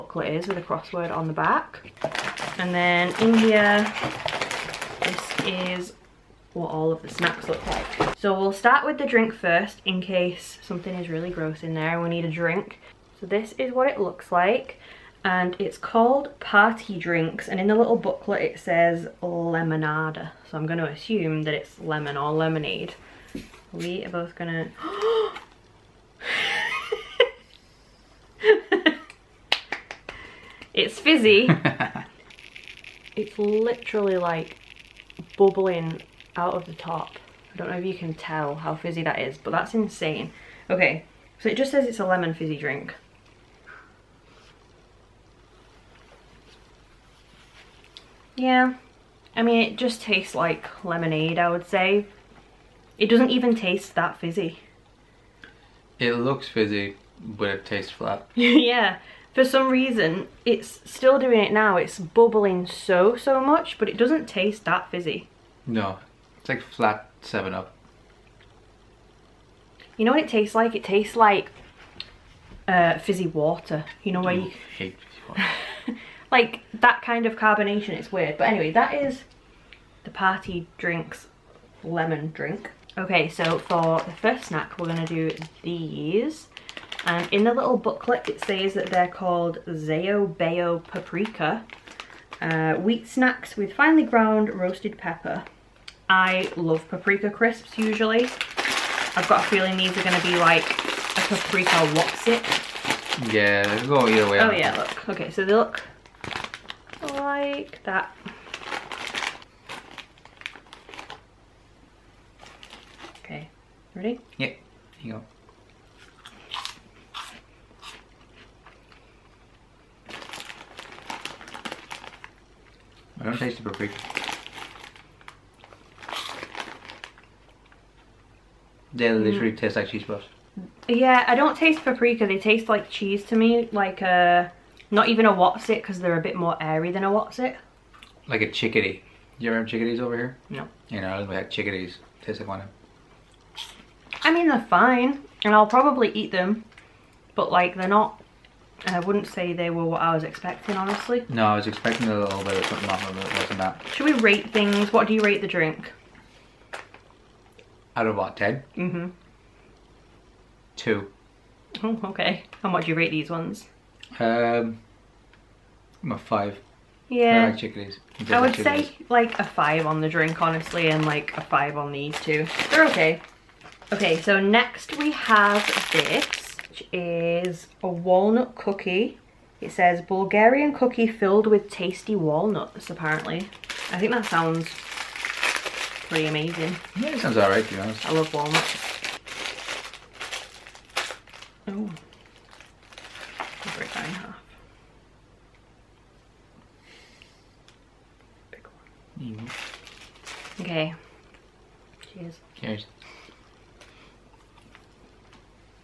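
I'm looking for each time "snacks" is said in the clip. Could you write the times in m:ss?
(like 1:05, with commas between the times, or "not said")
0:07, 1:24, 1:33.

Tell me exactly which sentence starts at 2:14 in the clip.
Uh, not even a whatsit because they're a bit more airy than a whatsit.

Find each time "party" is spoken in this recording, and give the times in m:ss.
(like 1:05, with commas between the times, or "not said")
0:16, 1:20.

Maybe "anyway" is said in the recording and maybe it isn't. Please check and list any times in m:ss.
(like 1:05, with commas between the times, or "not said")
1:18.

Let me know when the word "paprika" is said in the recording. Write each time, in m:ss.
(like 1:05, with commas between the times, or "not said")
1:30, 1:36, 1:41, 2:03, 2:11.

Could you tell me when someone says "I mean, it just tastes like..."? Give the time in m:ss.
0:49.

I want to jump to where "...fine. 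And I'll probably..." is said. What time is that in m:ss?
2:24.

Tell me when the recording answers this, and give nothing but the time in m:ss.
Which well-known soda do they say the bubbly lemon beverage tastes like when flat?
1:07.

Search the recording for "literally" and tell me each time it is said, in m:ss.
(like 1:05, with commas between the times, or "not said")
0:33, 2:09.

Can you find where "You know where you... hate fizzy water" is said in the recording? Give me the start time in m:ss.
1:14.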